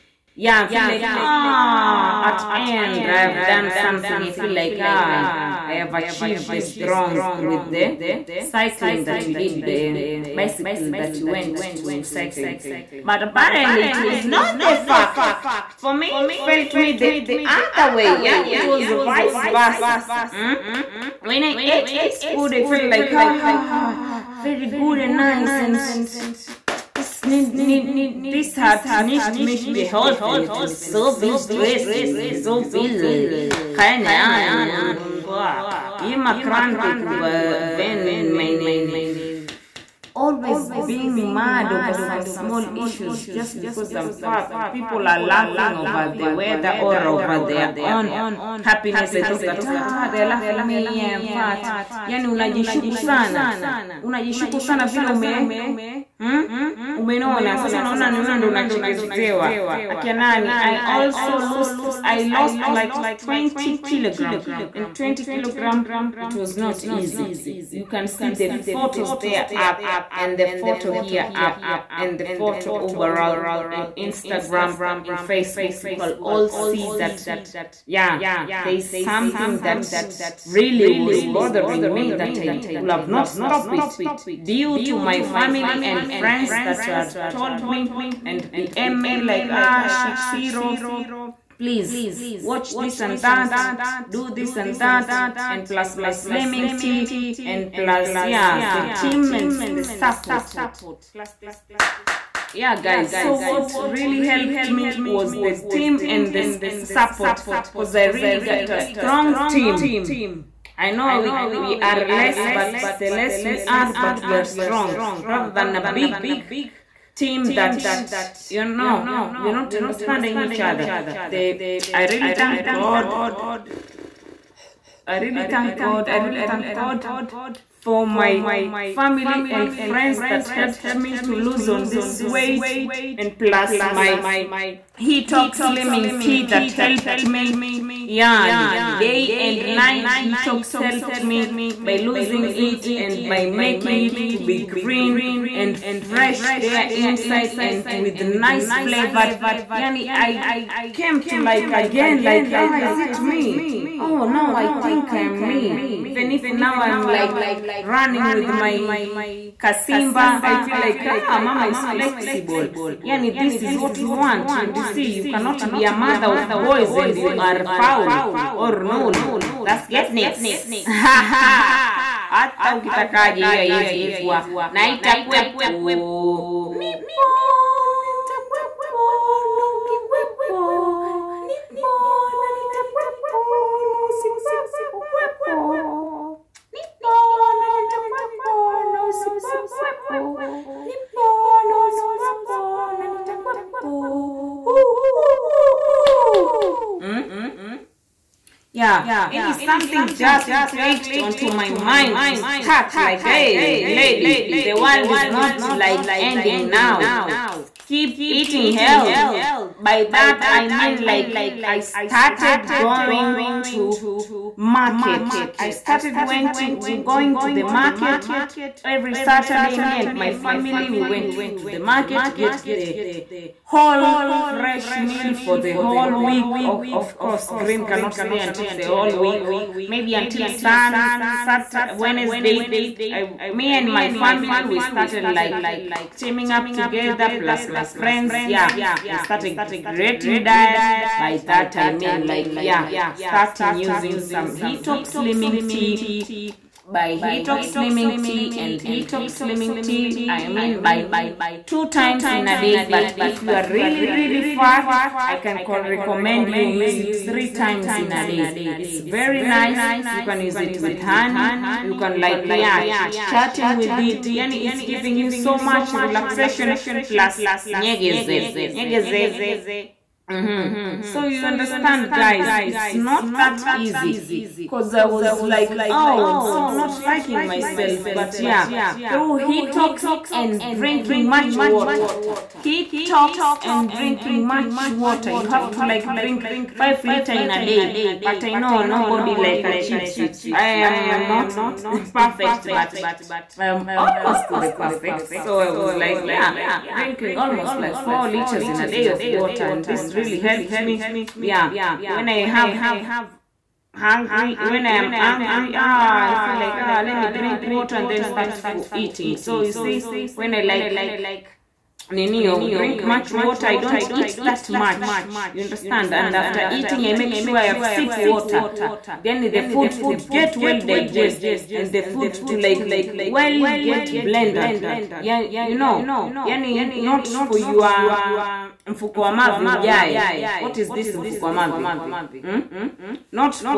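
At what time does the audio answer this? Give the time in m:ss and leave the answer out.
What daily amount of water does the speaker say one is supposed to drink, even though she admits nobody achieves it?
4:46.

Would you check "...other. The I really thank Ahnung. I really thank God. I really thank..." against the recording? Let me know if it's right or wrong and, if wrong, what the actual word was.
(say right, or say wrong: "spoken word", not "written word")
wrong: "God", not "Ahnung".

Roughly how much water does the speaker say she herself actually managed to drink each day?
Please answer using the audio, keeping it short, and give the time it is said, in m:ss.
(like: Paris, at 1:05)
4 liters, at 4:57.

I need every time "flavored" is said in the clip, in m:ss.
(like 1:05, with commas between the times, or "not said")
2:28.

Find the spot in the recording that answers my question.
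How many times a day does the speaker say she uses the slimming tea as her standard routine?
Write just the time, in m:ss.
4:11.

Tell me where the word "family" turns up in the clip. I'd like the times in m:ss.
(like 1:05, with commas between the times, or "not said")
1:25, 2:08, 3:40, 3:54.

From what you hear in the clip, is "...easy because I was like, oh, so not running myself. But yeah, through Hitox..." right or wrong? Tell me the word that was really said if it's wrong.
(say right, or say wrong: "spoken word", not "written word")
wrong: "liking", not "running".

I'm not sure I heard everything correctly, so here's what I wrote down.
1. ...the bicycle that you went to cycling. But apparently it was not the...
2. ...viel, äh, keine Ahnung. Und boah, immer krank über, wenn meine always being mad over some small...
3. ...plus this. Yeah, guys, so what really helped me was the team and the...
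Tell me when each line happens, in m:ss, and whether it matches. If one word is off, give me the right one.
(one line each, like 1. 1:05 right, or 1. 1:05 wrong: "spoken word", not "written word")
1. 0:09 right
2. 0:32 right
3. 1:41 right.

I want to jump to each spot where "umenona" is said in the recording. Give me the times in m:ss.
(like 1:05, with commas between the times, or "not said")
0:56.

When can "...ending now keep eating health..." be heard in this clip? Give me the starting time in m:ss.
3:26.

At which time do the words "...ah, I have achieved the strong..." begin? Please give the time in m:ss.
0:04.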